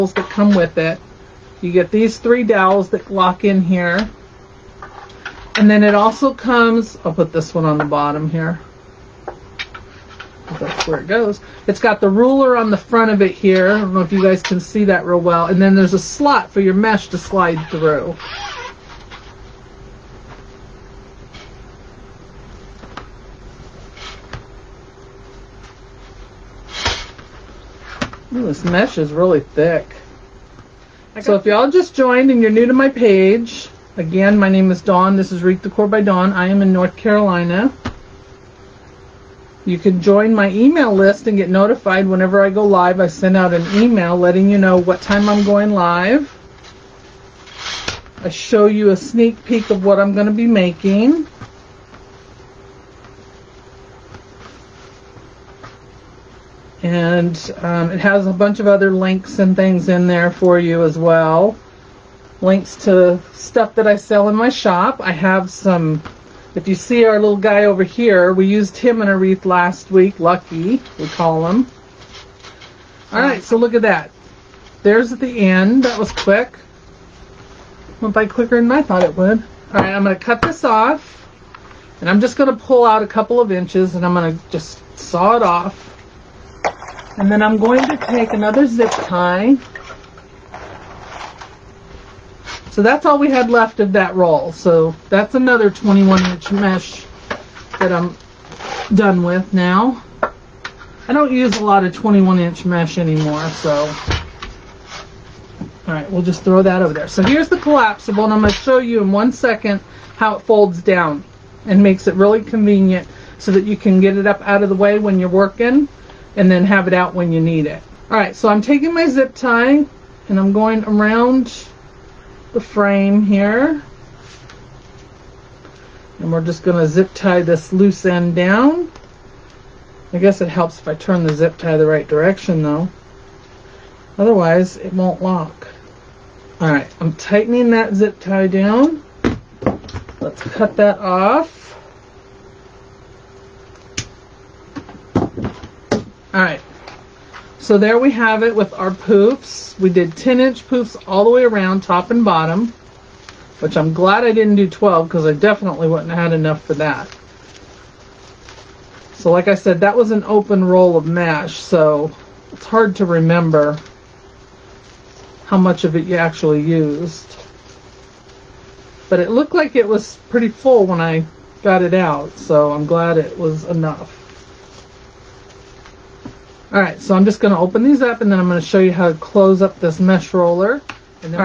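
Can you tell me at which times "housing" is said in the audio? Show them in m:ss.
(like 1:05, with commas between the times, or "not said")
not said.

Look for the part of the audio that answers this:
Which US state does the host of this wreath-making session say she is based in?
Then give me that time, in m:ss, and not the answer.
0:36.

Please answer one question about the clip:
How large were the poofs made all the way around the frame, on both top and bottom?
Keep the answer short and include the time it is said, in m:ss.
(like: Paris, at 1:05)
10 inch, at 2:30.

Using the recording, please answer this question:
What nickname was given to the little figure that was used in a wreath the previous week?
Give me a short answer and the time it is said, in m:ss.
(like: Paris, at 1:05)
Lucky, at 1:10.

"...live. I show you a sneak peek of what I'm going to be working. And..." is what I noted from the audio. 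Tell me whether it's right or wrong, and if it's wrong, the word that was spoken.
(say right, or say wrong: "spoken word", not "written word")
wrong: "making", not "working".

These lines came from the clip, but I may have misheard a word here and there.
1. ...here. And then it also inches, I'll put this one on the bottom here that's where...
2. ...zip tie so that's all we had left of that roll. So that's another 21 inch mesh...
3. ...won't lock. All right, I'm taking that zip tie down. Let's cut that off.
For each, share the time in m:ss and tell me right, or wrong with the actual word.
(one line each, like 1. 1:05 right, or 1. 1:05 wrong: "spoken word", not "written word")
1. 0:03 wrong: "comes", not "inches"
2. 1:28 right
3. 2:14 wrong: "tightening", not "taking".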